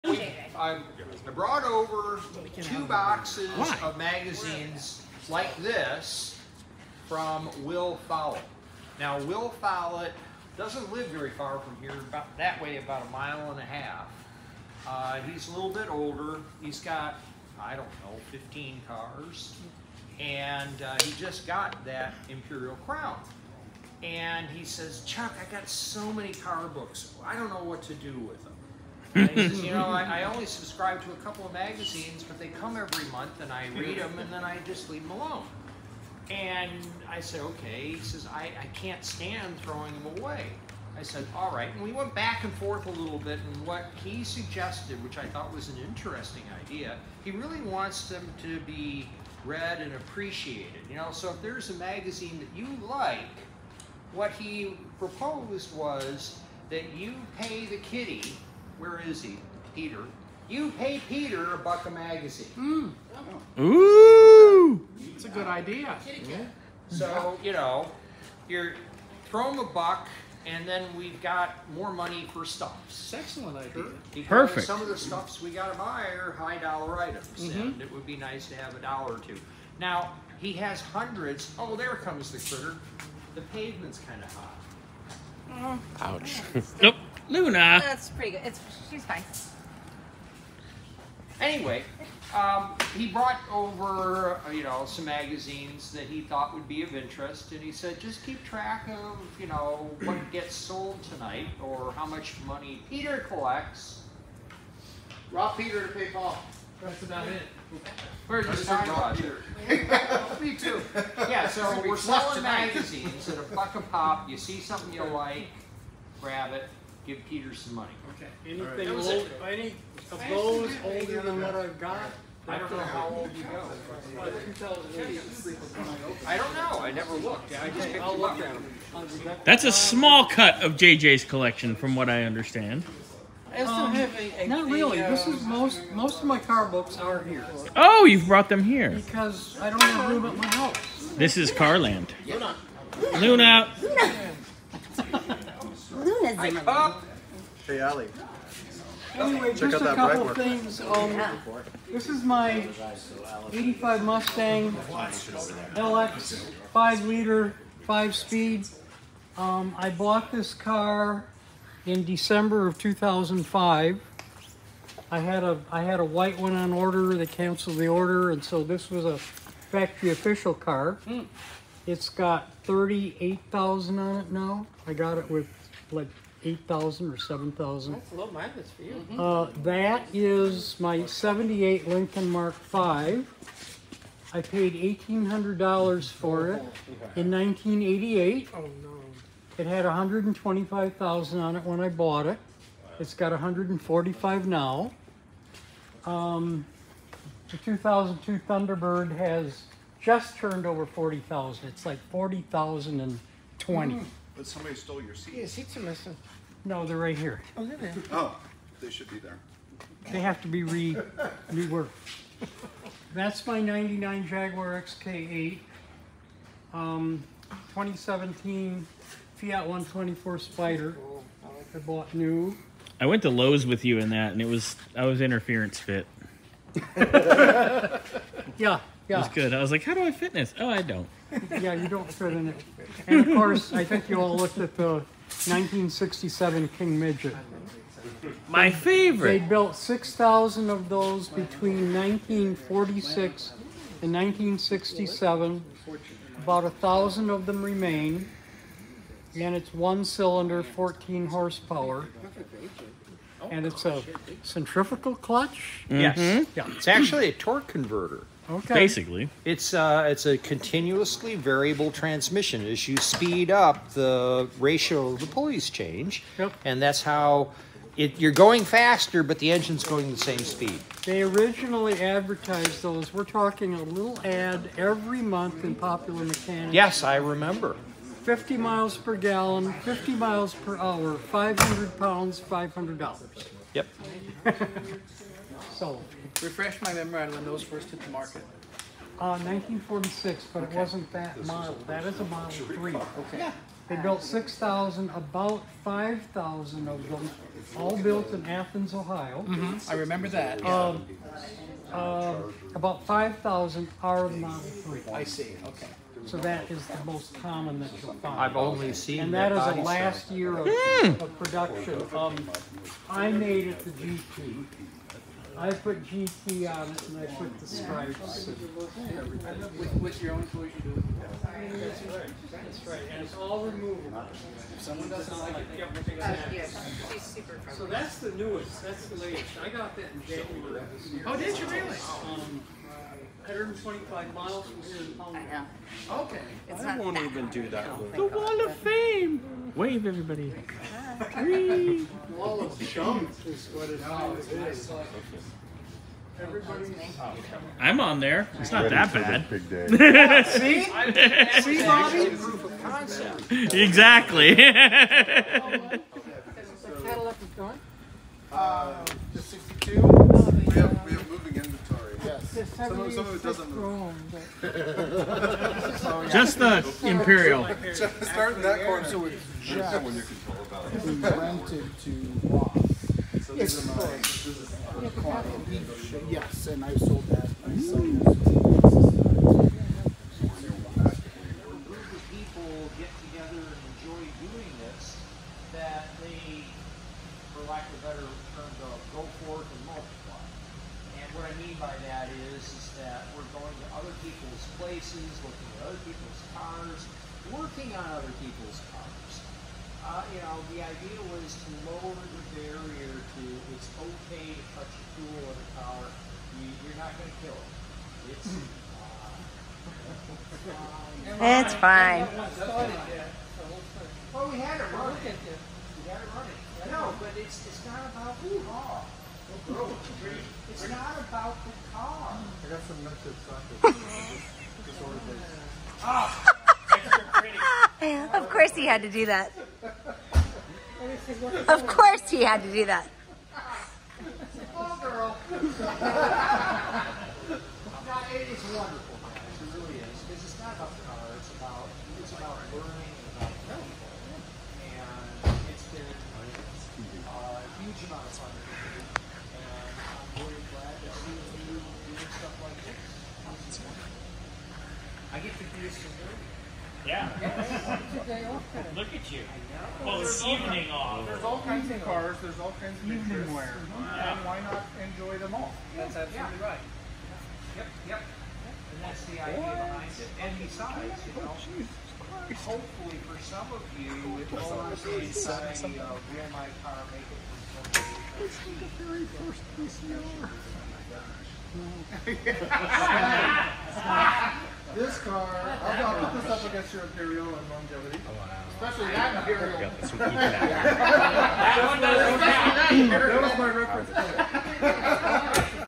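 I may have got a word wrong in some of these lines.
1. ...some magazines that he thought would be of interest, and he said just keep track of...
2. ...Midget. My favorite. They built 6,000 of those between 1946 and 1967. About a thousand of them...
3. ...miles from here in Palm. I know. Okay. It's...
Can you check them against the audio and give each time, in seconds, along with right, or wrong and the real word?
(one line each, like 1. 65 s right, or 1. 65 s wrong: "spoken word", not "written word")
1. 94 s right
2. 236 s right
3. 334 s right.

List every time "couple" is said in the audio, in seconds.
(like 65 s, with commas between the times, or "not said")
31 s, 149 s.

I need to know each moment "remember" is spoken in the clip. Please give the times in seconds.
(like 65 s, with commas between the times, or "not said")
277 s, 299 s.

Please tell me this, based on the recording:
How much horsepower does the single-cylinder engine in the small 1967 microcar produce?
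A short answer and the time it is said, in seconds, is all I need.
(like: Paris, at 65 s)
14, at 250 s.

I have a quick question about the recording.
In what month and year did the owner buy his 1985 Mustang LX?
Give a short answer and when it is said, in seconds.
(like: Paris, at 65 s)
December 2005, at 162 s.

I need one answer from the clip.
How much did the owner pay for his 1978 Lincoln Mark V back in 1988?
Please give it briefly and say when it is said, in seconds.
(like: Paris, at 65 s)
$1,800, at 184 s.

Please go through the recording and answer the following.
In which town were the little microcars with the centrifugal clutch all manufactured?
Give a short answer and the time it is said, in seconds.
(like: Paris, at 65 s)
Athens, Ohio, at 298 s.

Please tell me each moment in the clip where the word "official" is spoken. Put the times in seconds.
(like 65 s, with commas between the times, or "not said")
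170 s.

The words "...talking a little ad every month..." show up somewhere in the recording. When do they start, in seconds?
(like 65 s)
273 s.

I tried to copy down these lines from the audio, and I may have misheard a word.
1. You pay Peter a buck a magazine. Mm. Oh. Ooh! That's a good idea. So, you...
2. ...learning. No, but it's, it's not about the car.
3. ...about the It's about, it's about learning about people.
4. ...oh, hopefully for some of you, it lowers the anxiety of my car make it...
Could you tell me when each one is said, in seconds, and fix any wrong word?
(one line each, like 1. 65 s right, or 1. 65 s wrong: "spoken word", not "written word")
1. 60 s right
2. 416 s wrong: "running", not "learning"
3. 440 s right
4. 471 s right.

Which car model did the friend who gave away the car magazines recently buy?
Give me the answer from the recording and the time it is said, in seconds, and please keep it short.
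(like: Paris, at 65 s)
Imperial Crown, at 22 s.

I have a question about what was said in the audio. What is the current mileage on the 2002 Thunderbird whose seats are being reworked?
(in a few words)
40,020.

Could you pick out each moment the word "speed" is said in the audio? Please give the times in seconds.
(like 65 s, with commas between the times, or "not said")
158 s, 262 s, 270 s.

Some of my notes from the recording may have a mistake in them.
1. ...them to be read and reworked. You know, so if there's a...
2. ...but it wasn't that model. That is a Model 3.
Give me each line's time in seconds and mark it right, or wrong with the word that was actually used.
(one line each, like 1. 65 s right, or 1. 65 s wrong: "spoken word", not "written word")
1. 48 s wrong: "appreciated", not "reworked"
2. 290 s right.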